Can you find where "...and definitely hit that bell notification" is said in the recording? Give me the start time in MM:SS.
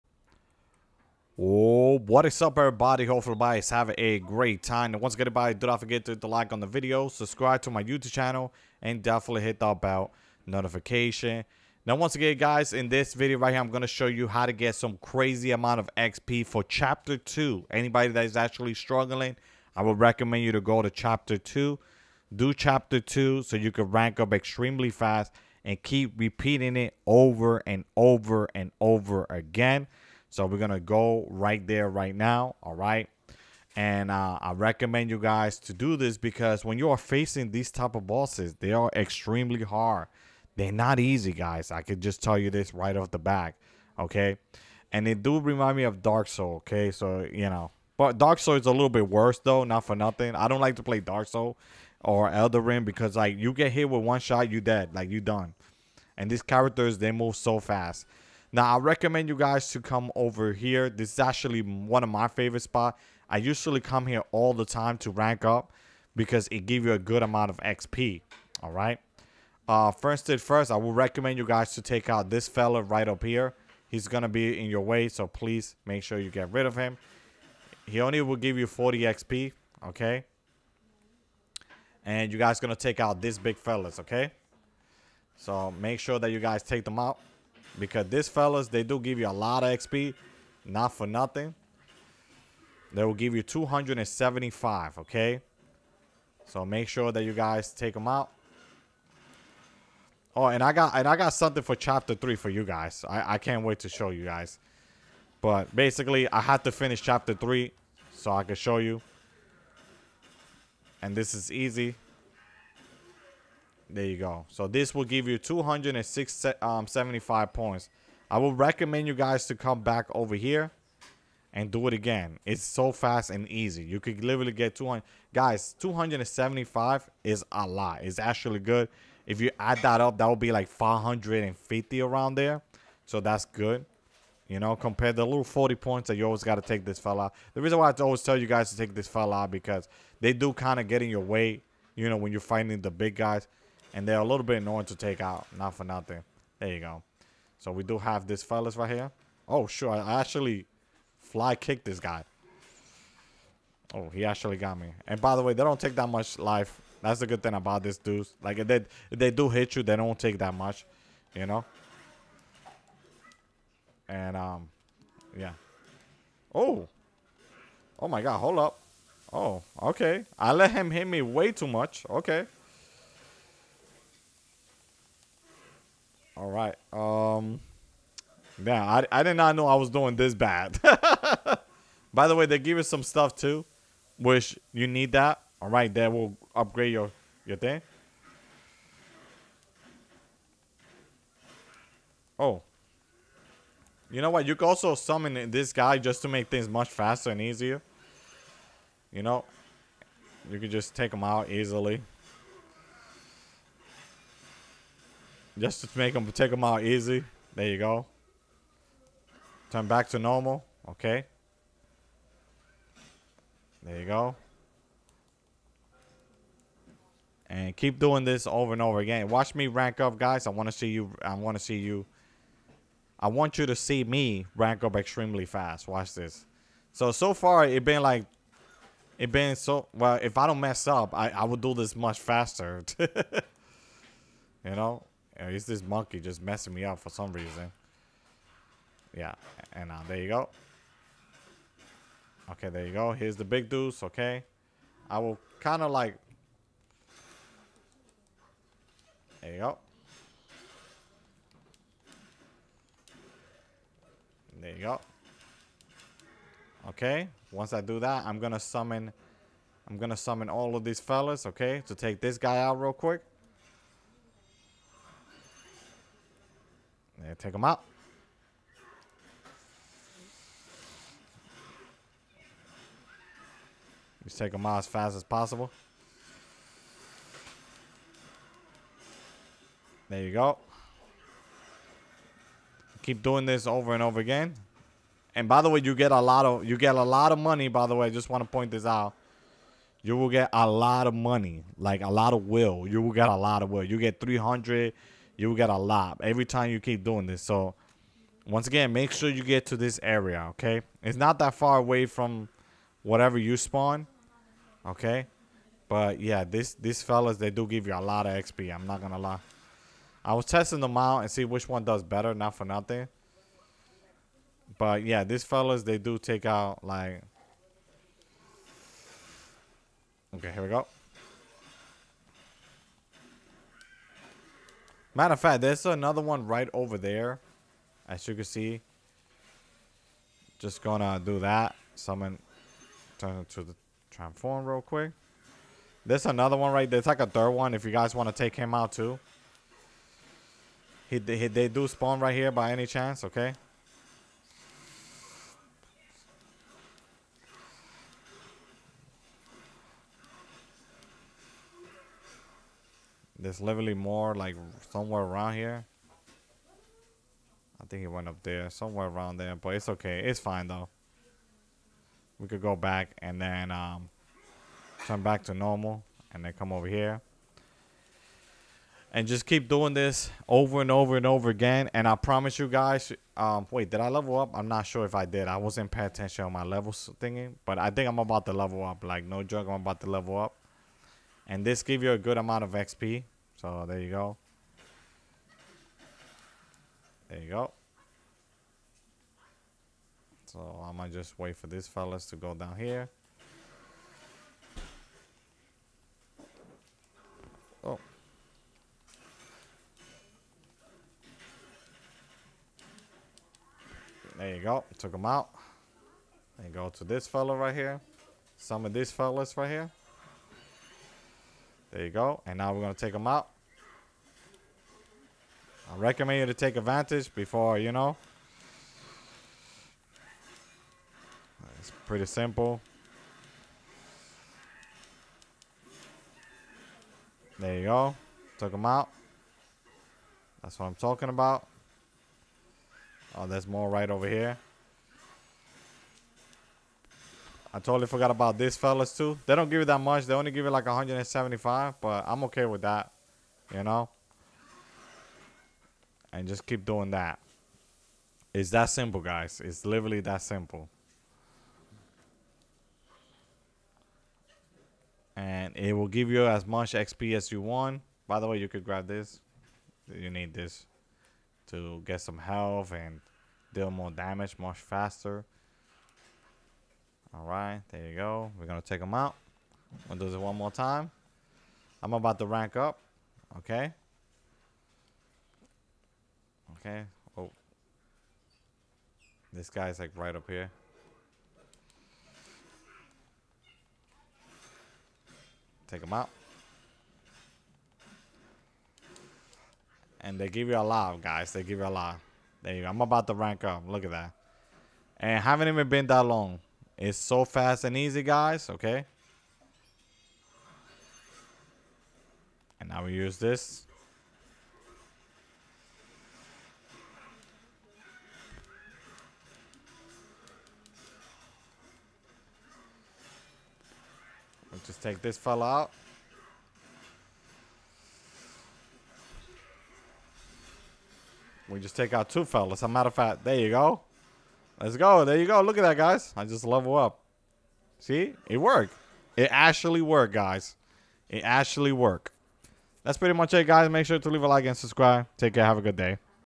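00:08.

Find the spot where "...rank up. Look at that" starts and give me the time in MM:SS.
08:13.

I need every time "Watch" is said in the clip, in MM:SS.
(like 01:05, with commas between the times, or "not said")
03:39, 03:45.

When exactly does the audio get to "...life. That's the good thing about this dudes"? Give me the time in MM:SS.
02:36.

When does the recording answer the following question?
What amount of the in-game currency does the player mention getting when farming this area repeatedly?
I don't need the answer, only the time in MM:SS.
04:54.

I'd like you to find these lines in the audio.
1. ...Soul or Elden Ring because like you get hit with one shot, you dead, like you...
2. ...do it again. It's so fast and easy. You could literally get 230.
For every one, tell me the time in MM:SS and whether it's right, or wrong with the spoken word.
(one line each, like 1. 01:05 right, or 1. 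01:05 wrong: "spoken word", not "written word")
1. 00:51 right
2. 02:01 wrong: "200", not "230".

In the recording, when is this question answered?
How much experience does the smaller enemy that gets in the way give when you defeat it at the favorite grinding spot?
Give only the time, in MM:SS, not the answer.
01:18.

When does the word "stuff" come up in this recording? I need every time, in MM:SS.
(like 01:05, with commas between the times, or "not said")
03:03.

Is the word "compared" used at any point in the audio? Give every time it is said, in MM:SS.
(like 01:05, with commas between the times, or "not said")
02:14.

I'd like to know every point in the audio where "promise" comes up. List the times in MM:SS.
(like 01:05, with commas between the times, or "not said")
06:12.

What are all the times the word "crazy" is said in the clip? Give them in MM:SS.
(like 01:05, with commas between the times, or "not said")
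00:15.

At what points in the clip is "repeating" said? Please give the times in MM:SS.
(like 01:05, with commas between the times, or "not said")
00:26.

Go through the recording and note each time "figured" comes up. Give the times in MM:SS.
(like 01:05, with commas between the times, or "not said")
not said.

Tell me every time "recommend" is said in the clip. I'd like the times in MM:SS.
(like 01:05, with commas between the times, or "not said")
00:19, 00:34, 00:58, 01:10, 01:58, 06:55.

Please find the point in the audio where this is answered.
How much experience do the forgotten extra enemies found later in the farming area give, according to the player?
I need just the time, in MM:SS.
07:20.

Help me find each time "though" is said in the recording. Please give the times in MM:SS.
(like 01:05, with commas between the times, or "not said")
00:49, 06:00.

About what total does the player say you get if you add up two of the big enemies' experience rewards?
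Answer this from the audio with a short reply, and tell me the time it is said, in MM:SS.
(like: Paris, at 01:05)
550, at 02:10.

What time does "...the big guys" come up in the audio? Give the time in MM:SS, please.
02:22.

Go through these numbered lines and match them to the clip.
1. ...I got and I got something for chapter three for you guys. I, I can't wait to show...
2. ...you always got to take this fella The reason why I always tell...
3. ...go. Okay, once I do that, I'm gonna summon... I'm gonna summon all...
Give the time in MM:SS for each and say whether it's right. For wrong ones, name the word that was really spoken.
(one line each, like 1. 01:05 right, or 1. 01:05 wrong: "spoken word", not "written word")
1. 01:40 right
2. 02:16 right
3. 04:14 right.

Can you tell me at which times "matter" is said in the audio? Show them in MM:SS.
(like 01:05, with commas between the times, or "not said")
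05:25, 08:42.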